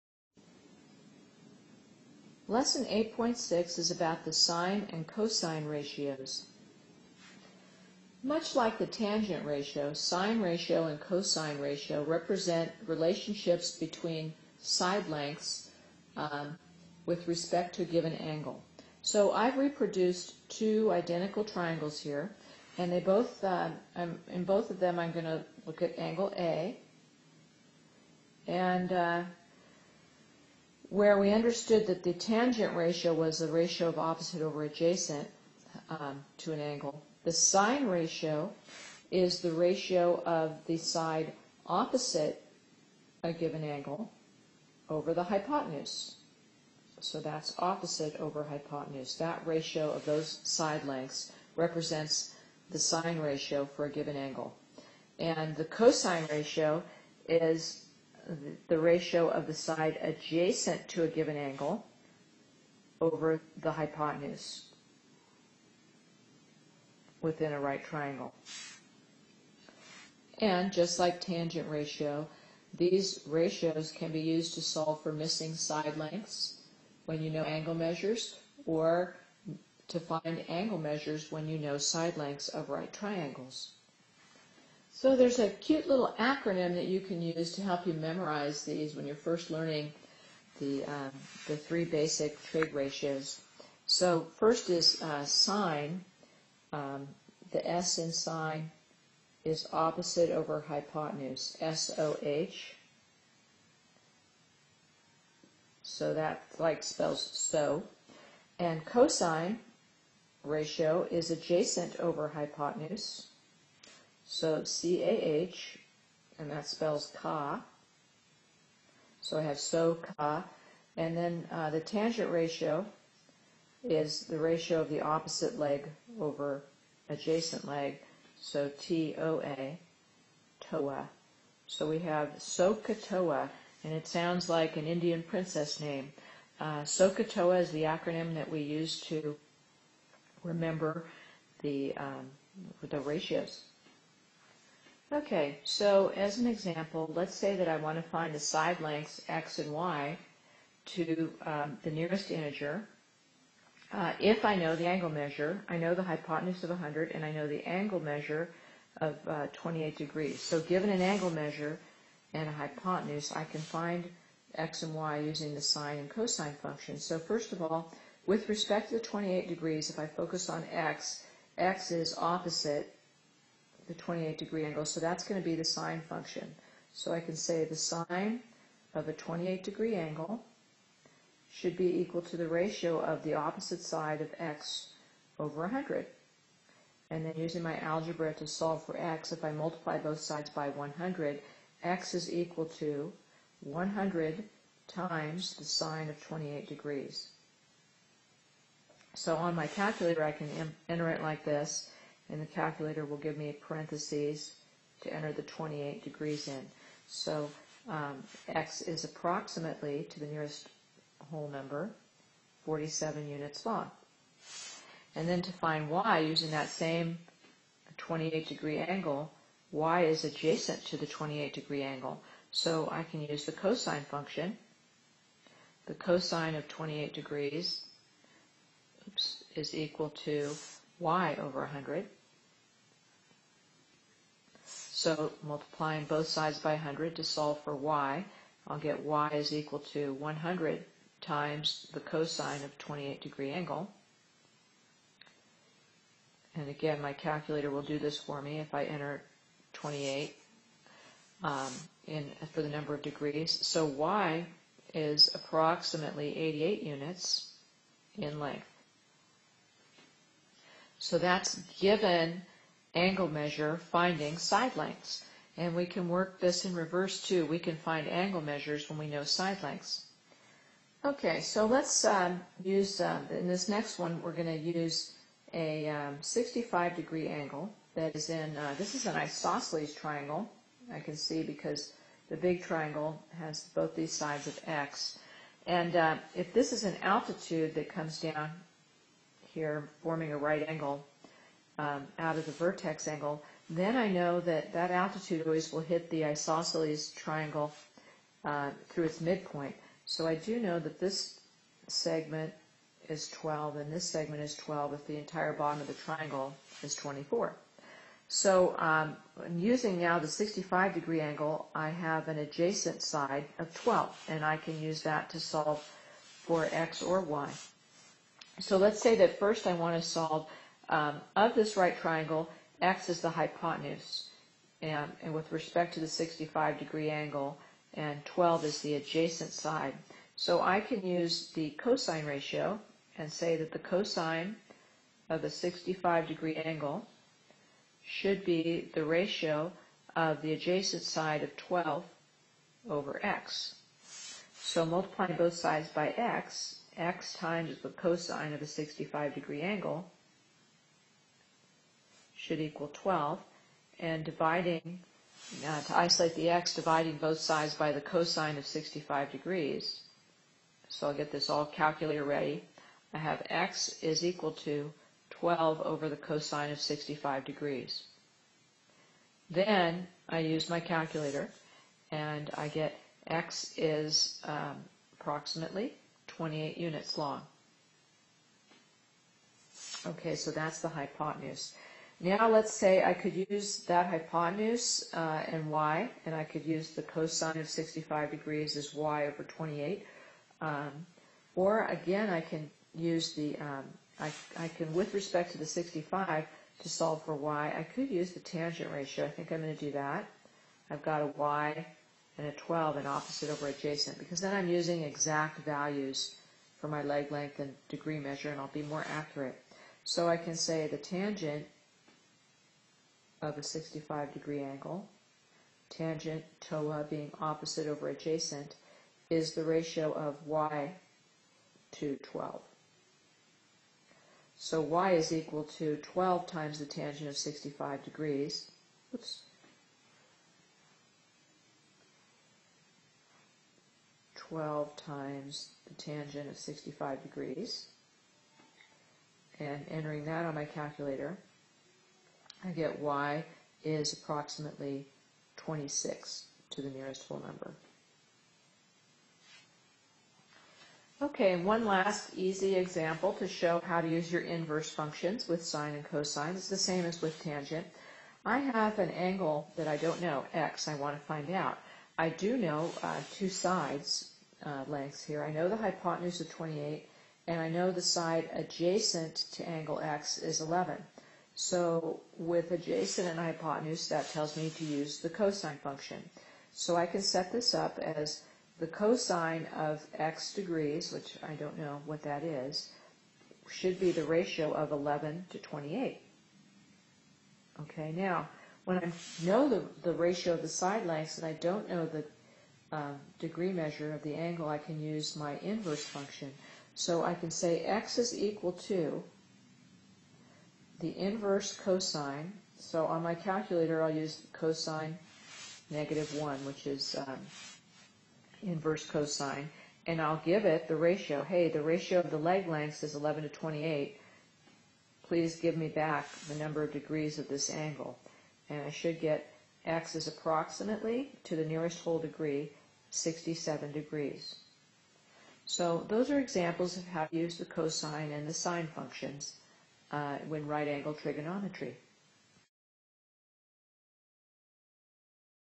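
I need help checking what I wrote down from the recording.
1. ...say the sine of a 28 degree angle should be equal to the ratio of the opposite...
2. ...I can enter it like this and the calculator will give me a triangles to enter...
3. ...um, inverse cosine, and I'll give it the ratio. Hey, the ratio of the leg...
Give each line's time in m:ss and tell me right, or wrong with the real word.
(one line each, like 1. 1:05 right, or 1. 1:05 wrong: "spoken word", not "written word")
1. 2:57 right
2. 3:20 wrong: "parentheses", not "triangles"
3. 8:27 right.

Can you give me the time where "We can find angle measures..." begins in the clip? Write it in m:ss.
4:27.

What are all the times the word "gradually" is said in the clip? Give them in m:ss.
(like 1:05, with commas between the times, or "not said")
not said.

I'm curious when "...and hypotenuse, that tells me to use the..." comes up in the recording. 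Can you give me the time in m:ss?
7:53.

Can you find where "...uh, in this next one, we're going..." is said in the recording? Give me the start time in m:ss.
4:33.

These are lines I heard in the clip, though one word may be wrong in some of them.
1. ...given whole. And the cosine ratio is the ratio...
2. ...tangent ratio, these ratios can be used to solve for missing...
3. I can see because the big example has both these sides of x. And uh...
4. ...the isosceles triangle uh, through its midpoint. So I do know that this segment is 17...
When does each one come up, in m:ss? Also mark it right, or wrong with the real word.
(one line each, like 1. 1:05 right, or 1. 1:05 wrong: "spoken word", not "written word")
1. 0:53 wrong: "angle", not "whole"
2. 1:11 right
3. 4:40 wrong: "triangle", not "example"
4. 4:56 wrong: "12", not "17".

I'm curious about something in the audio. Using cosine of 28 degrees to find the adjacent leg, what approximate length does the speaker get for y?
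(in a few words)
88.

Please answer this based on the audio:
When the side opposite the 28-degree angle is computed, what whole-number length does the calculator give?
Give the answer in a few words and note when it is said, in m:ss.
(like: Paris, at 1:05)
47, at 3:32.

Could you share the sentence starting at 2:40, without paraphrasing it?
So given an angle measure and a hypotenuse, I can find x and y using the sine and cosine functions.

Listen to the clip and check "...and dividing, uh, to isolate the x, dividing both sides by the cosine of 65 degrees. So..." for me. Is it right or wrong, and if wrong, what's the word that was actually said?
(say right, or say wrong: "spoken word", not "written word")
right.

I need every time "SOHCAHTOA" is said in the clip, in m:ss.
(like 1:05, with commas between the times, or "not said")
2:12, 2:16.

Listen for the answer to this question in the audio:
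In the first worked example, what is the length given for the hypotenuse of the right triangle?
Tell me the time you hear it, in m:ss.
2:36.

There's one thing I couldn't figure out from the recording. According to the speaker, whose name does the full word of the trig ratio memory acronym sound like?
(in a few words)
Indian princess.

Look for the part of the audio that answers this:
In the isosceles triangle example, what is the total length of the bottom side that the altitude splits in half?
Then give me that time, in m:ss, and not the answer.
5:06.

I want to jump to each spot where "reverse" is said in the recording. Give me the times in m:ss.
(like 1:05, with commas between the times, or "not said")
4:26.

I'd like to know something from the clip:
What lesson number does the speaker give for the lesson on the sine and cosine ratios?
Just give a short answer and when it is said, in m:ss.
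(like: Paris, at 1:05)
8.6, at 0:02.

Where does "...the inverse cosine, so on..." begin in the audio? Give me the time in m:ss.
8:21.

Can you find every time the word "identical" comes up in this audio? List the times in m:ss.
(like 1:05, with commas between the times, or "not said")
0:20.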